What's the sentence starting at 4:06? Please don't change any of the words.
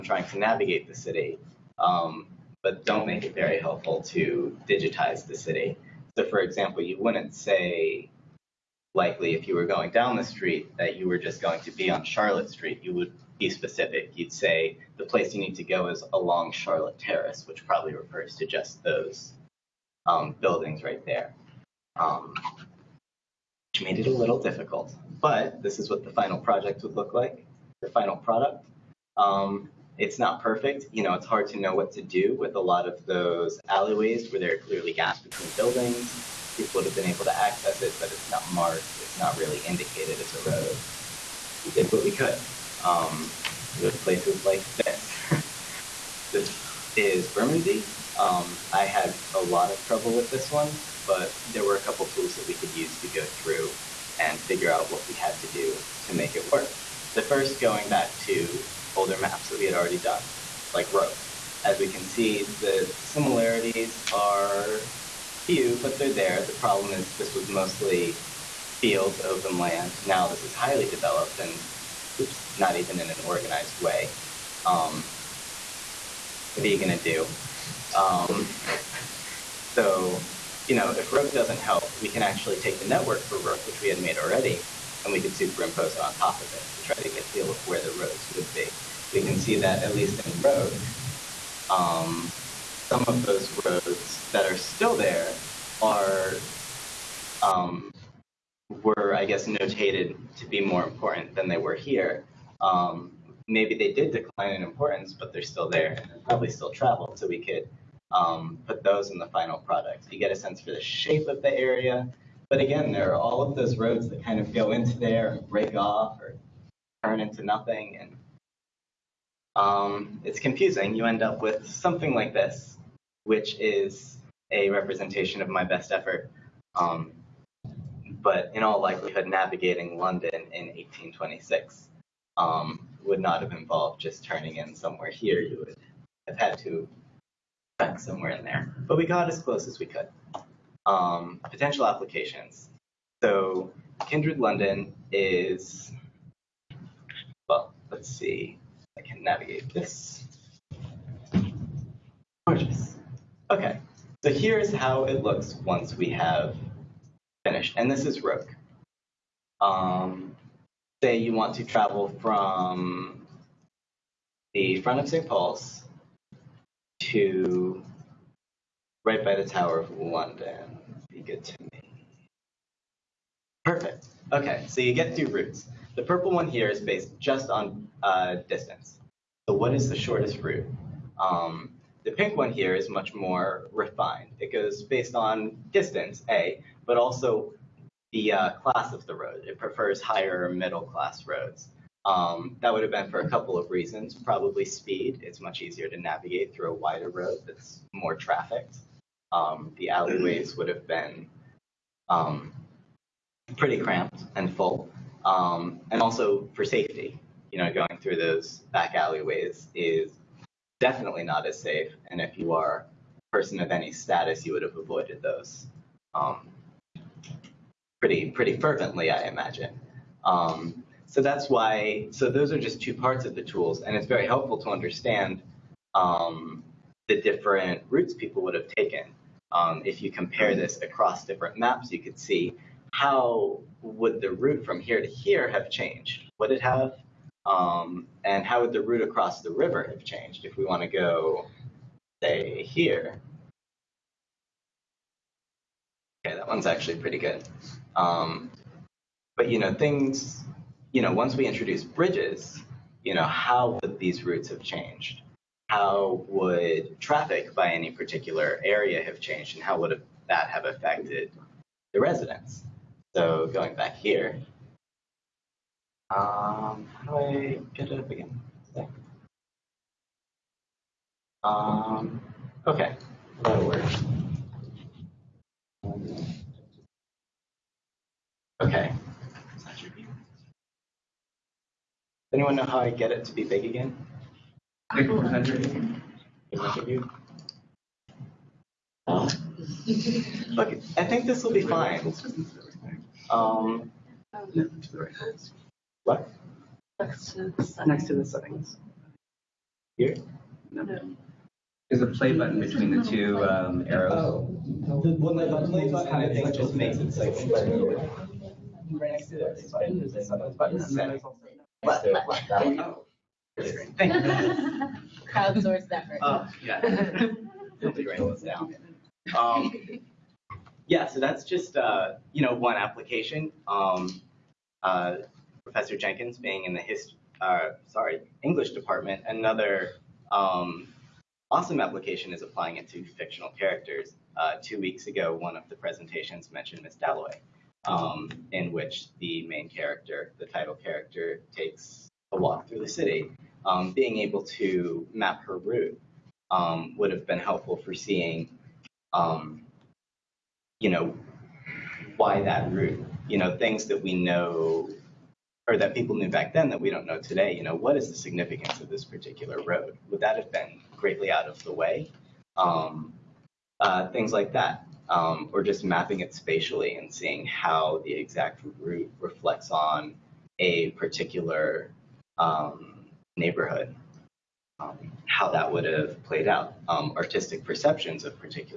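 Okay, that one's actually pretty good.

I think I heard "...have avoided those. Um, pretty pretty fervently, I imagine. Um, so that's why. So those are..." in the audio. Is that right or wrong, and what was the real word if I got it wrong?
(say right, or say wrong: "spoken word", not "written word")
right.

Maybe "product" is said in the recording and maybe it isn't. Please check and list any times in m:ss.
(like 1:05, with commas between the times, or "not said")
0:28, 1:49.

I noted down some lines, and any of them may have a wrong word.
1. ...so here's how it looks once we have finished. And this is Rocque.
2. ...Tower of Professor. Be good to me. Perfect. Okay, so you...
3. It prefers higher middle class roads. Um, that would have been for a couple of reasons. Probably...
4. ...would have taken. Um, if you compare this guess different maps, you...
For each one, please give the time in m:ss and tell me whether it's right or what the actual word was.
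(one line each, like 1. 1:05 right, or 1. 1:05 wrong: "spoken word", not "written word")
1. 2:34 right
2. 2:49 wrong: "London", not "Professor"
3. 3:09 right
4. 3:48 wrong: "across", not "guess".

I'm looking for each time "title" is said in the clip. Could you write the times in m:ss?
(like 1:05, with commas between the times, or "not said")
5:40.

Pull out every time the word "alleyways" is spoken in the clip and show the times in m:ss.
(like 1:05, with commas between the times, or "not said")
0:33, 3:19, 3:28.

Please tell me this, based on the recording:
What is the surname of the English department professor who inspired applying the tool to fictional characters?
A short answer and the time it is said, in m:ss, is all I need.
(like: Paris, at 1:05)
Jenkins, at 5:25.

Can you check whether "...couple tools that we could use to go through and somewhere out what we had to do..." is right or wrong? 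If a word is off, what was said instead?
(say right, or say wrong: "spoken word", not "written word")
wrong: "figure", not "somewhere".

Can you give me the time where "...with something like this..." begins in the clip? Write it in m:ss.
2:01.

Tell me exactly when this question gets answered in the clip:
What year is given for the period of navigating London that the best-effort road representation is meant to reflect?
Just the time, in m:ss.
2:10.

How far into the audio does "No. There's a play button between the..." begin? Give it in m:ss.
5:00.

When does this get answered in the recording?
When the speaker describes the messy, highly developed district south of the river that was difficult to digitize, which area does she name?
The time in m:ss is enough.
0:47.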